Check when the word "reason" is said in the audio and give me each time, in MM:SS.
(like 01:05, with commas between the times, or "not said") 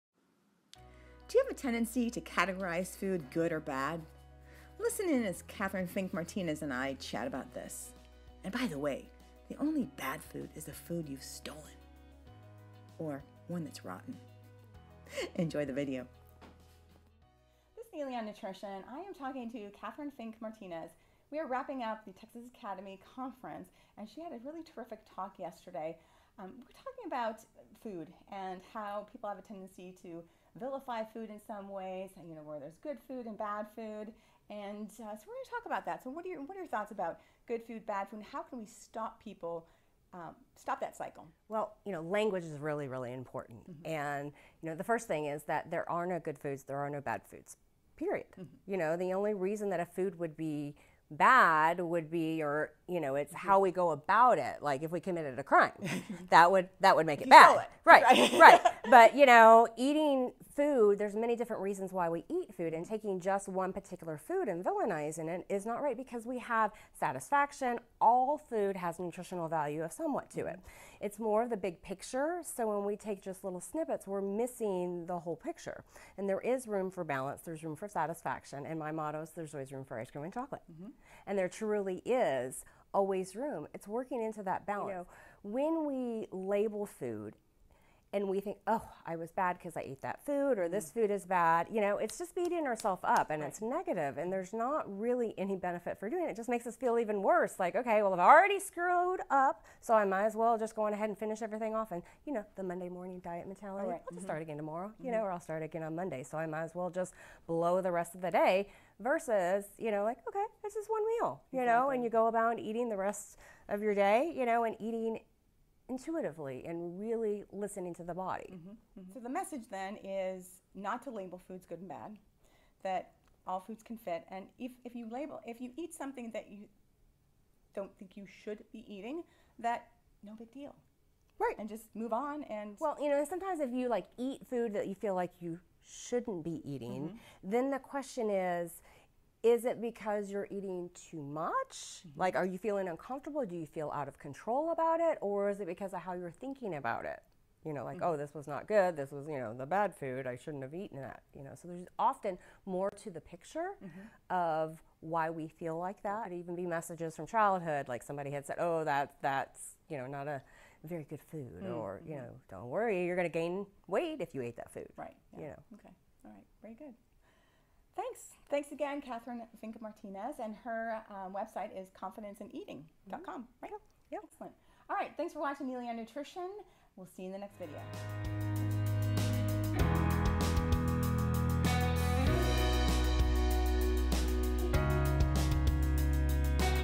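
00:49, 01:01.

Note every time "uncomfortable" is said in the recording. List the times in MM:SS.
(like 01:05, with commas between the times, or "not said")
02:22.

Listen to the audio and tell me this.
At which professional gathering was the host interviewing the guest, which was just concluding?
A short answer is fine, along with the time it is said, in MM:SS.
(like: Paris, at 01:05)
Texas Academy Conference, at 00:22.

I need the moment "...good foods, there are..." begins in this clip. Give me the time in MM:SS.
00:46.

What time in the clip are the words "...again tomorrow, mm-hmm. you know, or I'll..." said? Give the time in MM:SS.
01:44.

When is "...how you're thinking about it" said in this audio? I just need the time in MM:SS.
02:26.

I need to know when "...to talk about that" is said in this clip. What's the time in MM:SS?
00:35.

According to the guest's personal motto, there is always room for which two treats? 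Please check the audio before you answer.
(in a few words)
ice cream and chocolate.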